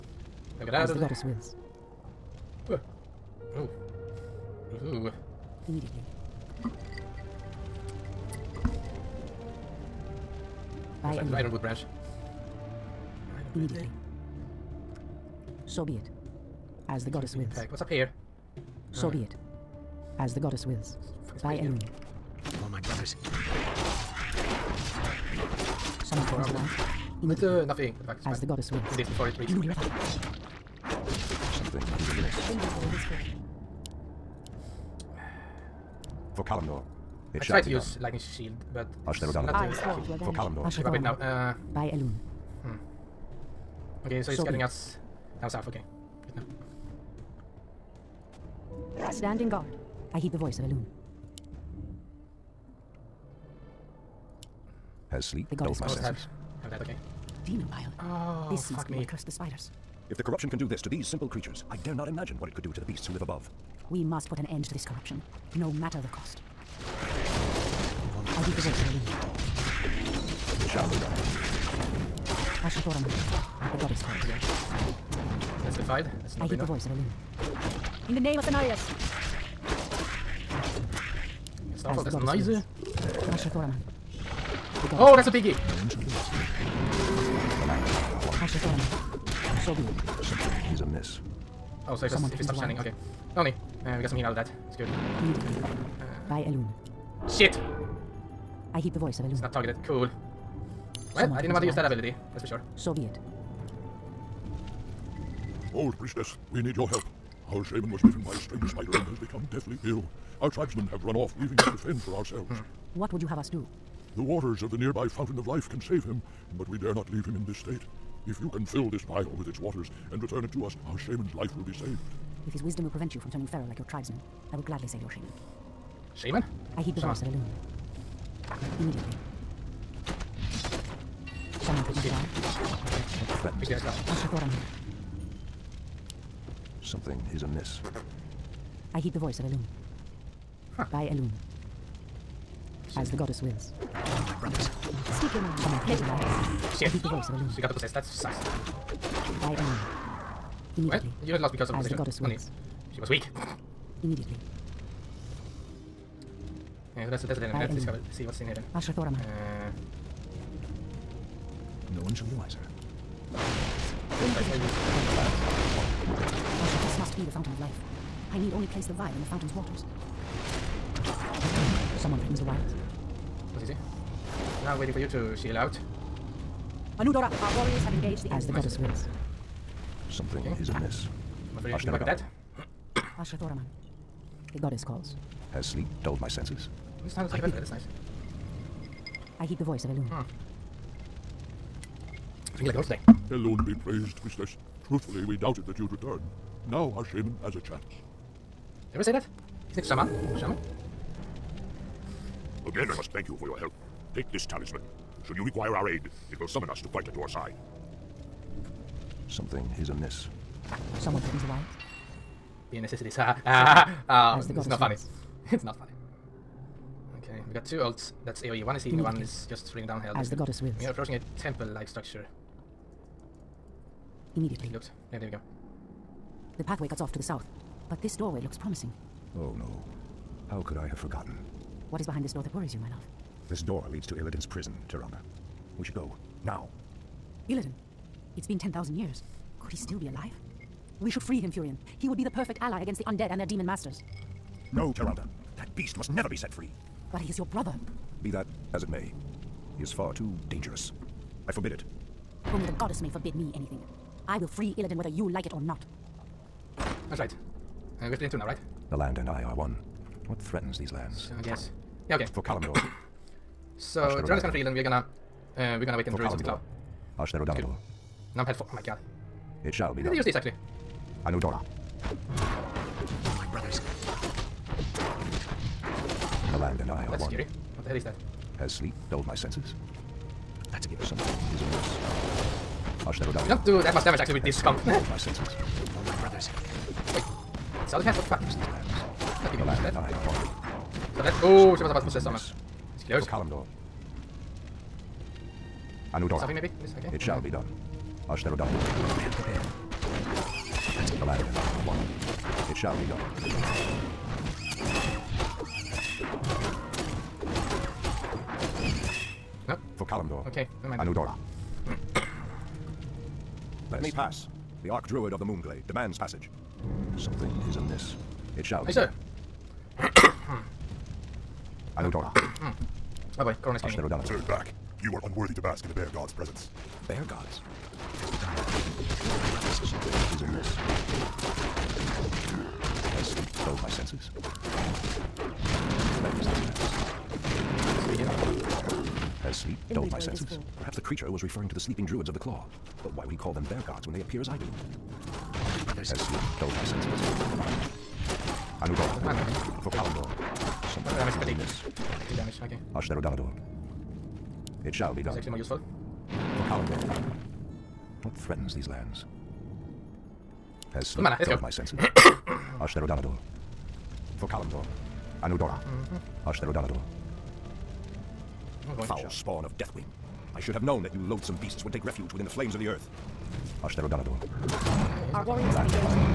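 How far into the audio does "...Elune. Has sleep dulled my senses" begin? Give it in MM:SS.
00:50.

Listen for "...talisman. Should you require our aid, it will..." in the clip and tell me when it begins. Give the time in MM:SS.
03:24.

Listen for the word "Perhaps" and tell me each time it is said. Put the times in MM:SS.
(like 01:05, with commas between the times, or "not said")
05:40.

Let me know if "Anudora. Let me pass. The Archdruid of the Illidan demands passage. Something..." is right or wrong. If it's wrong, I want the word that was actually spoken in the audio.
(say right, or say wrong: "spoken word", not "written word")
wrong: "Moonglade", not "Illidan".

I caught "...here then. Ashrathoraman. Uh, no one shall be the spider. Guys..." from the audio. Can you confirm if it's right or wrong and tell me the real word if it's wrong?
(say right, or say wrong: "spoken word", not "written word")
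wrong: "wiser", not "spider".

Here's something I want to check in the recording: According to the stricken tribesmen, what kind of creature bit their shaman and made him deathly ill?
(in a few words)
A strange spider.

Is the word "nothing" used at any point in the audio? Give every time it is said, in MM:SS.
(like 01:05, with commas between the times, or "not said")
00:27.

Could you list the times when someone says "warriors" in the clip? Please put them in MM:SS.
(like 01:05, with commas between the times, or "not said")
02:57, 06:15.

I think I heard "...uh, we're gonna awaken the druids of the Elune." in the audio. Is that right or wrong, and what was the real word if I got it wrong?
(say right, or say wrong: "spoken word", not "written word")
wrong: "Claw", not "Elune".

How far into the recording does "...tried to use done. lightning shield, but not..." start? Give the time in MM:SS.
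00:37.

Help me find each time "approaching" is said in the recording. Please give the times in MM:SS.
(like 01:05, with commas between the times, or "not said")
03:40.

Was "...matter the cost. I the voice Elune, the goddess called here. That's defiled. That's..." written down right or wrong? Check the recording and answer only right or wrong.
wrong.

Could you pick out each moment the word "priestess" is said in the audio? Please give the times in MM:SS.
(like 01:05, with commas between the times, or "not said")
01:45, 03:14.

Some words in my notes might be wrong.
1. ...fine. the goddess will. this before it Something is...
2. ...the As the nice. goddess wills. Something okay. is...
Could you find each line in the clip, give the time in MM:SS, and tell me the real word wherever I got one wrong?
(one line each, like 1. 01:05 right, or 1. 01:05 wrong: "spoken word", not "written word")
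1. 00:28 right
2. 02:58 right.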